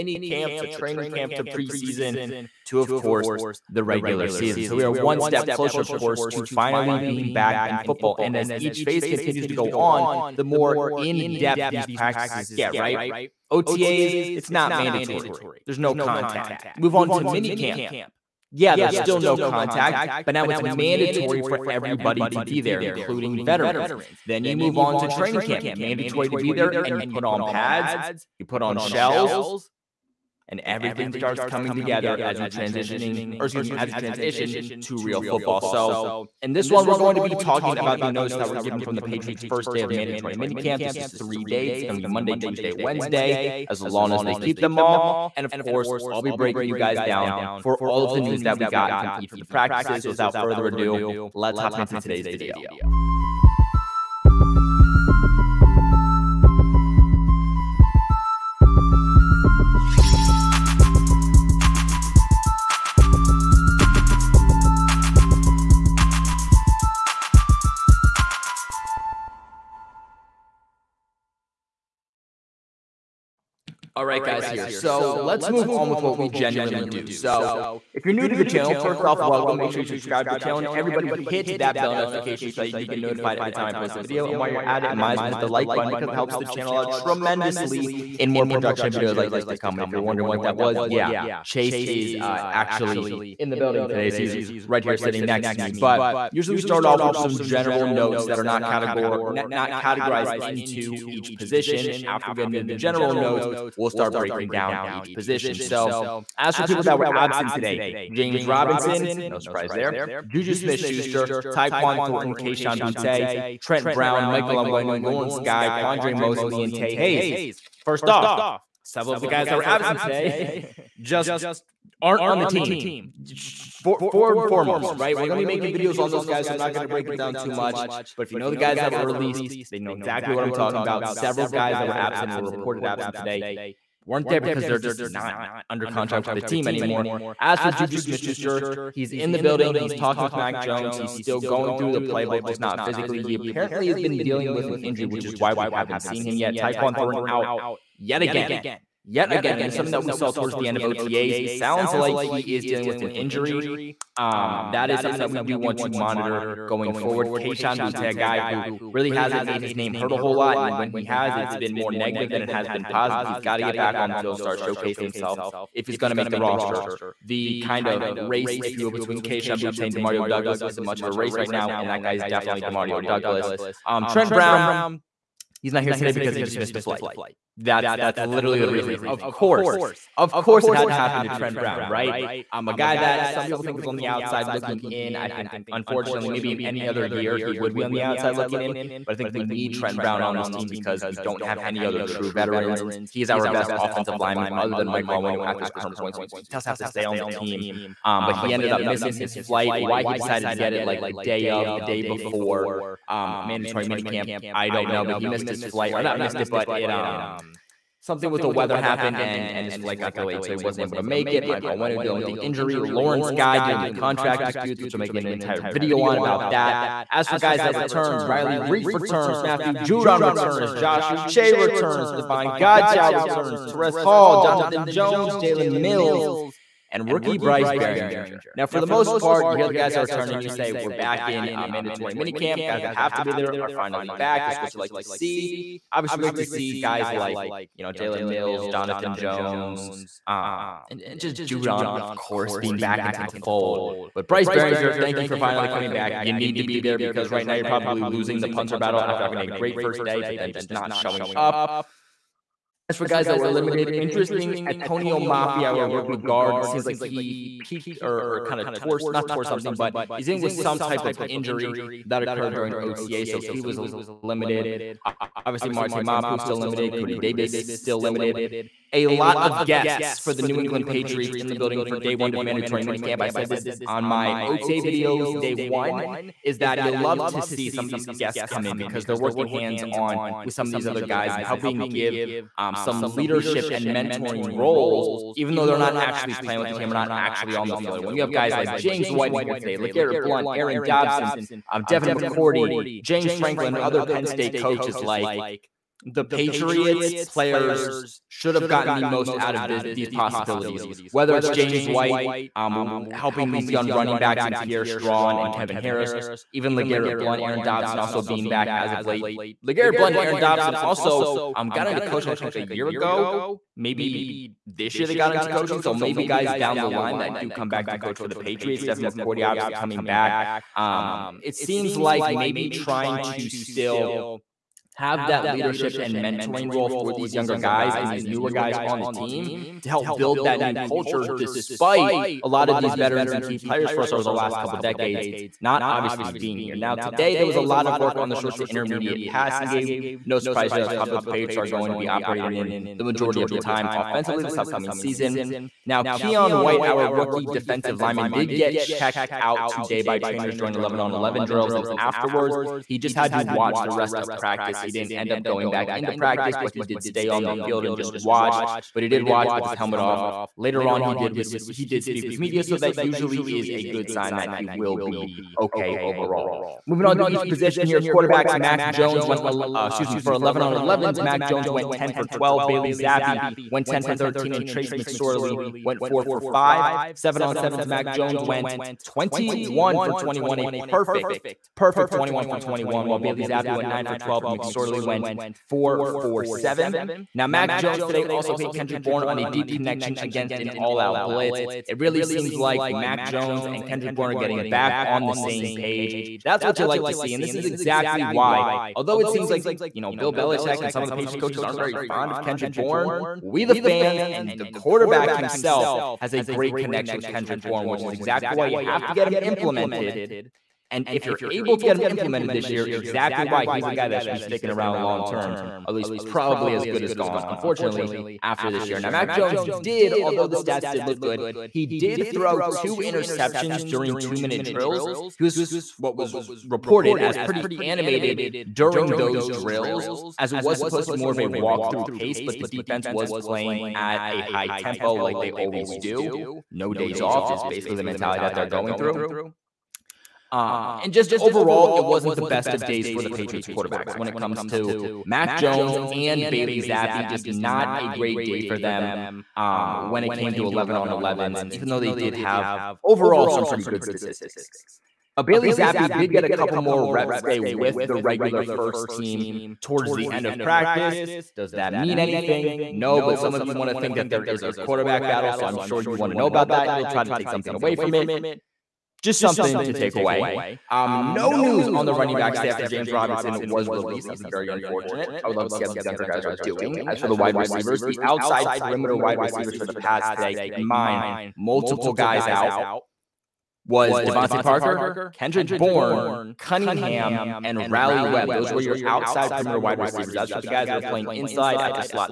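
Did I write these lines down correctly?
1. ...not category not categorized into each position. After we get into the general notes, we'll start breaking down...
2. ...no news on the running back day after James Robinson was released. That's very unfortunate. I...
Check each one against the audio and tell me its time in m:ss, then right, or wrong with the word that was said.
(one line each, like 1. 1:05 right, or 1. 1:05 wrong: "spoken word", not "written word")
1. 1:38 right
2. 7:51 right.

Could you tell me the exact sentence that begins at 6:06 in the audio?
Moving on to each position here, quarterbacks.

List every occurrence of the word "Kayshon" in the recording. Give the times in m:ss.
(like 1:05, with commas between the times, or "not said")
1:52, 2:37, 2:49.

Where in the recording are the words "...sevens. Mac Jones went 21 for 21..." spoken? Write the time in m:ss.
6:17.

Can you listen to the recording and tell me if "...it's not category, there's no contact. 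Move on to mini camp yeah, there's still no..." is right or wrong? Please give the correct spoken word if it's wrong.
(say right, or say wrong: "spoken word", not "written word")
wrong: "mandatory", not "category".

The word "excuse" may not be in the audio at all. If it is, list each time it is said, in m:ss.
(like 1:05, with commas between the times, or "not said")
0:33, 6:09.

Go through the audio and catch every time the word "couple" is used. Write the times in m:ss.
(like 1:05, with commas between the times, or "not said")
5:34, 7:36.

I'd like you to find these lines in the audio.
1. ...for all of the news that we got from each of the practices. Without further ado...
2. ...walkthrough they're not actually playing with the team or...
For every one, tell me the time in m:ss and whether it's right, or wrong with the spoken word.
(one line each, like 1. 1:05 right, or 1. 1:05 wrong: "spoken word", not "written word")
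1. 0:47 right
2. 4:45 wrong: "though", not "walkthrough".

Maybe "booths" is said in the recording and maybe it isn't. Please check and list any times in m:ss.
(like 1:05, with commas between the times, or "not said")
not said.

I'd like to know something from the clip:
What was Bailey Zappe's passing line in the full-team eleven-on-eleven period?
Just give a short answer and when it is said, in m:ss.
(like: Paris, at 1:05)
10 for 13, at 6:13.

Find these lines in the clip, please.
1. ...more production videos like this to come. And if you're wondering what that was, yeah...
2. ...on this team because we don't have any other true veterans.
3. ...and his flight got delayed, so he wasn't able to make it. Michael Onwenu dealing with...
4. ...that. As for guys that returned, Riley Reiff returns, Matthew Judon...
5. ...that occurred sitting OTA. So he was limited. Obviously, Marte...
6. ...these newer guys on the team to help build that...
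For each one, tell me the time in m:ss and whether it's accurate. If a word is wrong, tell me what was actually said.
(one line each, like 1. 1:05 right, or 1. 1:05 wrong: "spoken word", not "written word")
1. 1:28 right
2. 3:10 right
3. 3:29 right
4. 3:36 right
5. 4:22 wrong: "during", not "sitting"
6. 5:28 right.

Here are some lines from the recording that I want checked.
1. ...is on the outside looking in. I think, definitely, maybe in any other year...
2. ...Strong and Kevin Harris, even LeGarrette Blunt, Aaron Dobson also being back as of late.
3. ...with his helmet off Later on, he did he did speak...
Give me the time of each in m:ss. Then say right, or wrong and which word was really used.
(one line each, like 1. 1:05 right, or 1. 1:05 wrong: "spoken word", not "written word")
1. 3:03 wrong: "unfortunately", not "definitely"
2. 5:04 right
3. 5:59 right.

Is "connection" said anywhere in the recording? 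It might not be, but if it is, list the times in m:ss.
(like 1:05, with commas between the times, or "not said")
6:29, 6:46.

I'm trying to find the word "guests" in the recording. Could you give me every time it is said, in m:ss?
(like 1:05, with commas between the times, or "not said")
4:29, 4:38.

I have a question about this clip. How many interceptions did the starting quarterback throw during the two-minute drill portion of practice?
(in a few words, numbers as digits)
2.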